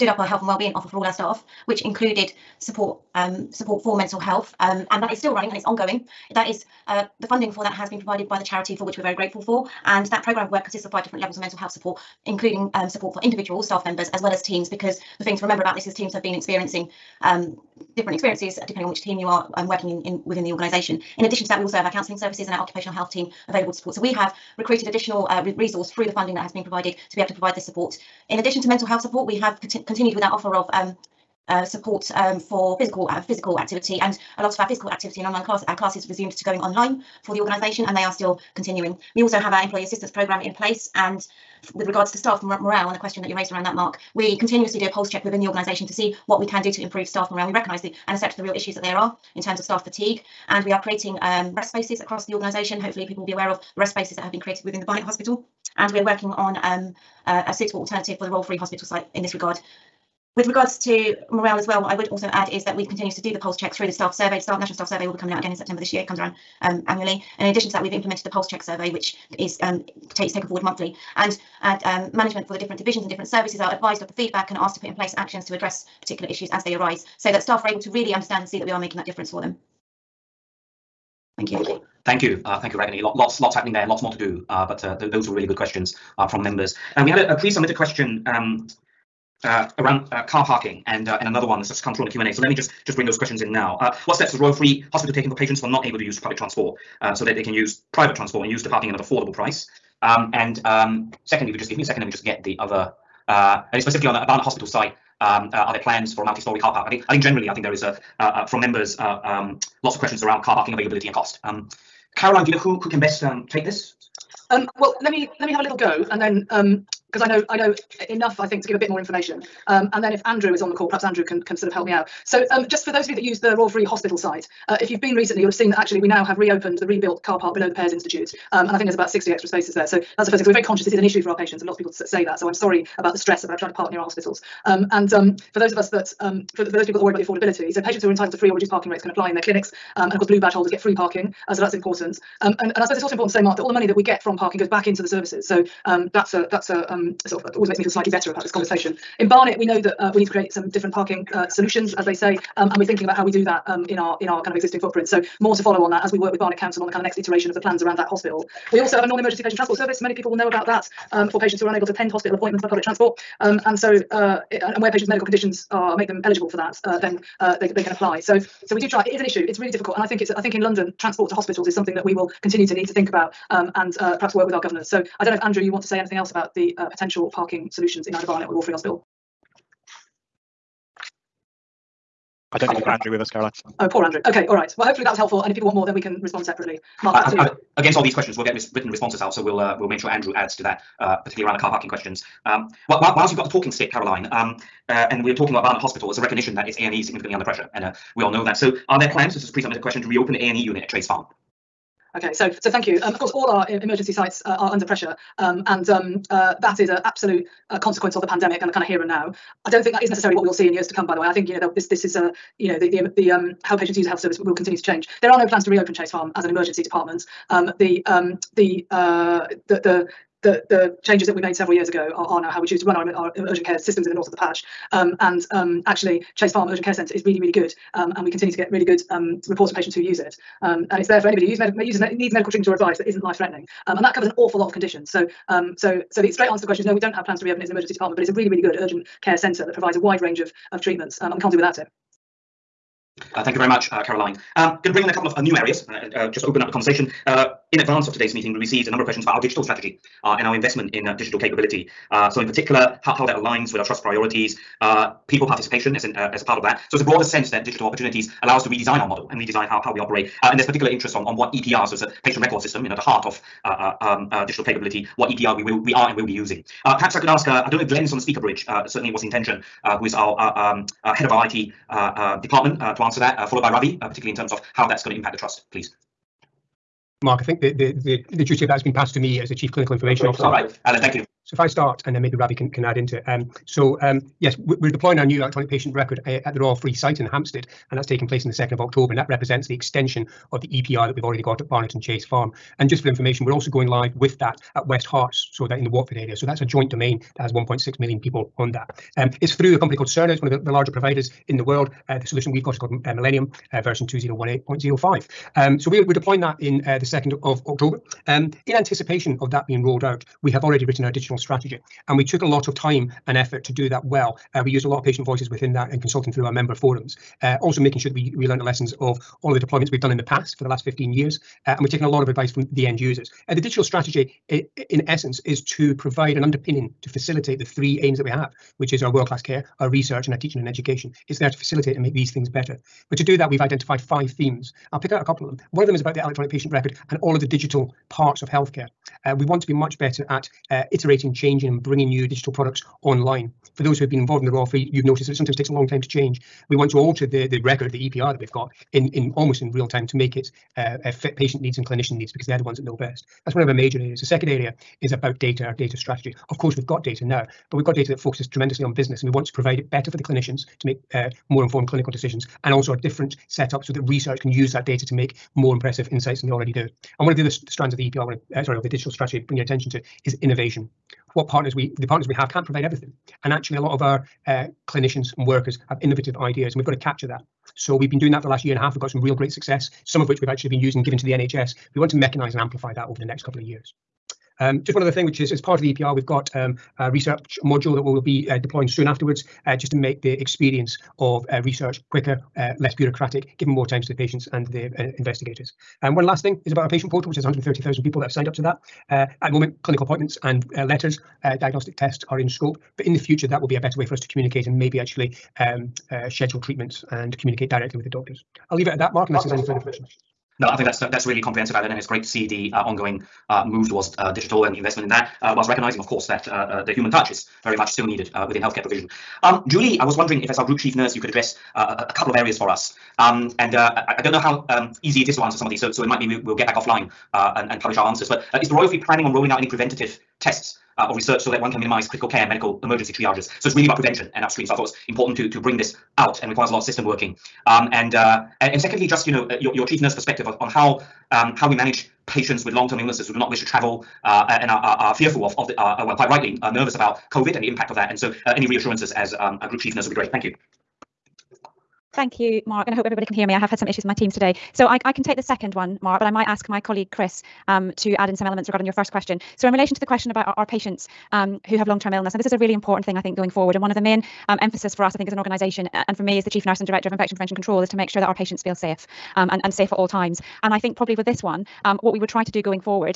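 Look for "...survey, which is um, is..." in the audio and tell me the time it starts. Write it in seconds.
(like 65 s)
68 s.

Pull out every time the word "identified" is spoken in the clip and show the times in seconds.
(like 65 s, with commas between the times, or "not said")
333 s.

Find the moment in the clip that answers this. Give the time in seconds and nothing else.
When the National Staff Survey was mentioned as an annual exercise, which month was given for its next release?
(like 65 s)
65 s.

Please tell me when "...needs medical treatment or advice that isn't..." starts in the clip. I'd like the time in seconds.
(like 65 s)
231 s.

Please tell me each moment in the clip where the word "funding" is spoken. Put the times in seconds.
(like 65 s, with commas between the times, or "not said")
7 s, 26 s.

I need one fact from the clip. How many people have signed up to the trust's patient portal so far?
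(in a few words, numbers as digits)
130,000.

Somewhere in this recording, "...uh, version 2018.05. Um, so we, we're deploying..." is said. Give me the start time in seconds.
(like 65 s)
303 s.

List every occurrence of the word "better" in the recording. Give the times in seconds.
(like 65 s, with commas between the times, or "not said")
148 s, 332 s, 339 s, 359 s, 403 s.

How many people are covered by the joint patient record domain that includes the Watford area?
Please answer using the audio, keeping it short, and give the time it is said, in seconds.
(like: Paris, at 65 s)
1.6 million, at 297 s.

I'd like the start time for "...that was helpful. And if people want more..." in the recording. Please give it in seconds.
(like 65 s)
185 s.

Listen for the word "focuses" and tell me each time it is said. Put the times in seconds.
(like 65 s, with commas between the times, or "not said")
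358 s.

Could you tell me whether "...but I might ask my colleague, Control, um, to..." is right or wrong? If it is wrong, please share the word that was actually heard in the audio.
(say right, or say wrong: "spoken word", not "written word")
wrong: "Chris", not "Control".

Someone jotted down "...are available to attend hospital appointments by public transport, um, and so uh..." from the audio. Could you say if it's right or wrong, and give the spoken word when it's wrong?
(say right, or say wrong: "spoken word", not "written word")
wrong: "unable", not "available".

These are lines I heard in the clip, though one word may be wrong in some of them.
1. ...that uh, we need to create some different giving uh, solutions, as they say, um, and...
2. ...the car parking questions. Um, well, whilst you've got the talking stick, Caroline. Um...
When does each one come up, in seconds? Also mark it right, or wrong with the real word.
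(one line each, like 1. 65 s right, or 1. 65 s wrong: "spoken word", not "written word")
1. 149 s wrong: "parking", not "giving"
2. 191 s right.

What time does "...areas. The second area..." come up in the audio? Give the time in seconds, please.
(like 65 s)
353 s.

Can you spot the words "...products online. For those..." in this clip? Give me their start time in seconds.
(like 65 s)
342 s.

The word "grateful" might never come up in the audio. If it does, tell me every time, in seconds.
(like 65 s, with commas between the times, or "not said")
9 s.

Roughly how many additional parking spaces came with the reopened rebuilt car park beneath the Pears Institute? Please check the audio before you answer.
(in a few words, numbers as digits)
60.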